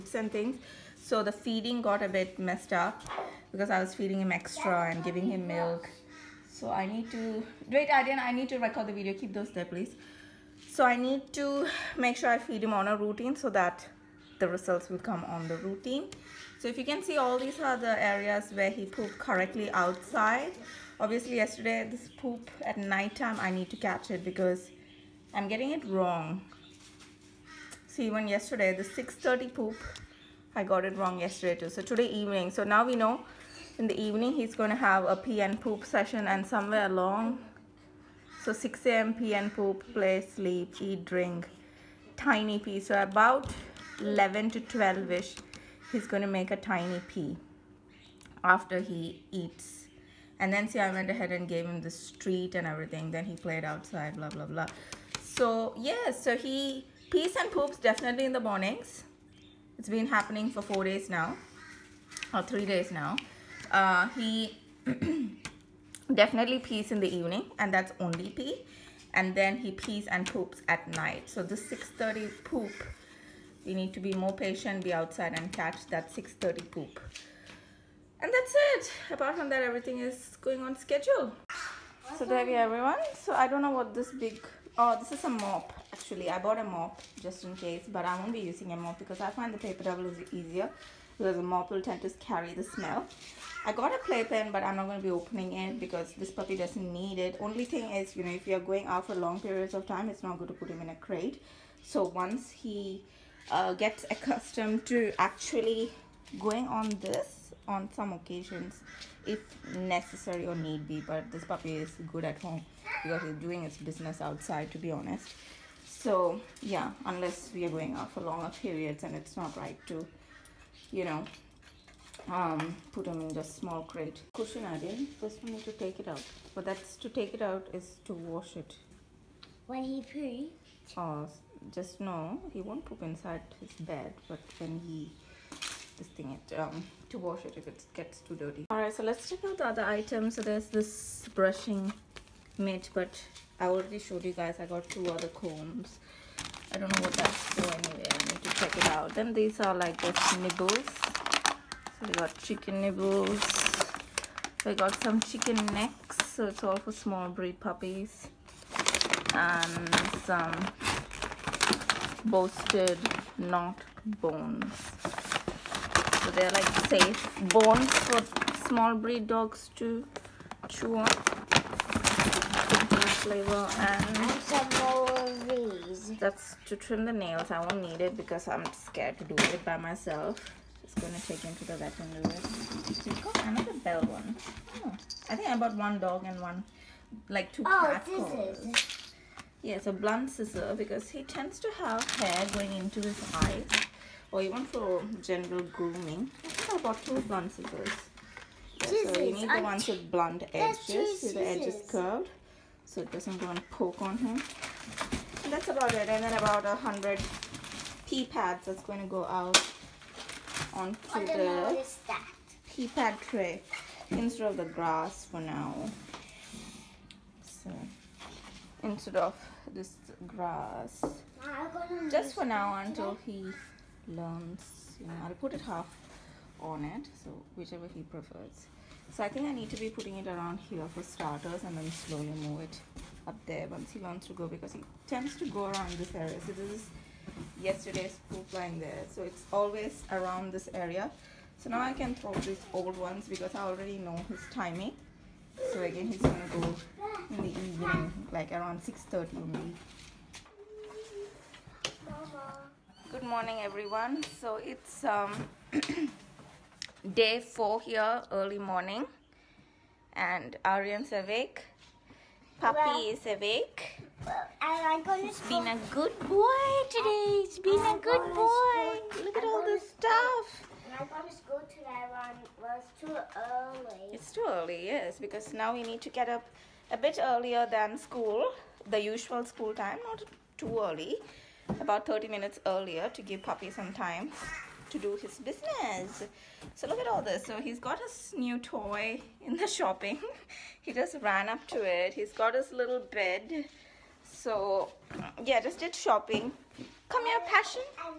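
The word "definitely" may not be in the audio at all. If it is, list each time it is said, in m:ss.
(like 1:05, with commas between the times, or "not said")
0:57, 1:06.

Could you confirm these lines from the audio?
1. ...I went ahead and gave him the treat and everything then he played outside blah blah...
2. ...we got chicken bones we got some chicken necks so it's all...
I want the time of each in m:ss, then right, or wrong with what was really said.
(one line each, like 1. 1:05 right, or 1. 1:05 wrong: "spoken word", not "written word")
1. 0:50 right
2. 2:32 wrong: "nibbles", not "bones".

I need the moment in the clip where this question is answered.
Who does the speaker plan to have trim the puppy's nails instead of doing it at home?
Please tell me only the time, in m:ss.
3:01.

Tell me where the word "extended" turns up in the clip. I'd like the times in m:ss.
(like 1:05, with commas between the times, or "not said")
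not said.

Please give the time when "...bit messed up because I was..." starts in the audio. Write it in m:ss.
0:02.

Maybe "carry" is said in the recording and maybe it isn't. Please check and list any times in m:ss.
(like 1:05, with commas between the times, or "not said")
1:32.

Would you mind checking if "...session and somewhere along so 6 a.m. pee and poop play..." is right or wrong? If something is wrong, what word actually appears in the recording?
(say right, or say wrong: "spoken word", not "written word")
right.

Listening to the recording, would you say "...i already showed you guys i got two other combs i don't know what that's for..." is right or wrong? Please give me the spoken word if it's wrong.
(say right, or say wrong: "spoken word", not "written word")
right.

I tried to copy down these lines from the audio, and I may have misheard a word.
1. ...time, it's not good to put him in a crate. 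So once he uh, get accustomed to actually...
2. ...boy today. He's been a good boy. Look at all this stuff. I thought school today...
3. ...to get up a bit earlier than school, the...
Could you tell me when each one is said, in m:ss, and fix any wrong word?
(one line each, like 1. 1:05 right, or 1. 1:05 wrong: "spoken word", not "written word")
1. 1:39 right
2. 4:26 right
3. 4:36 right.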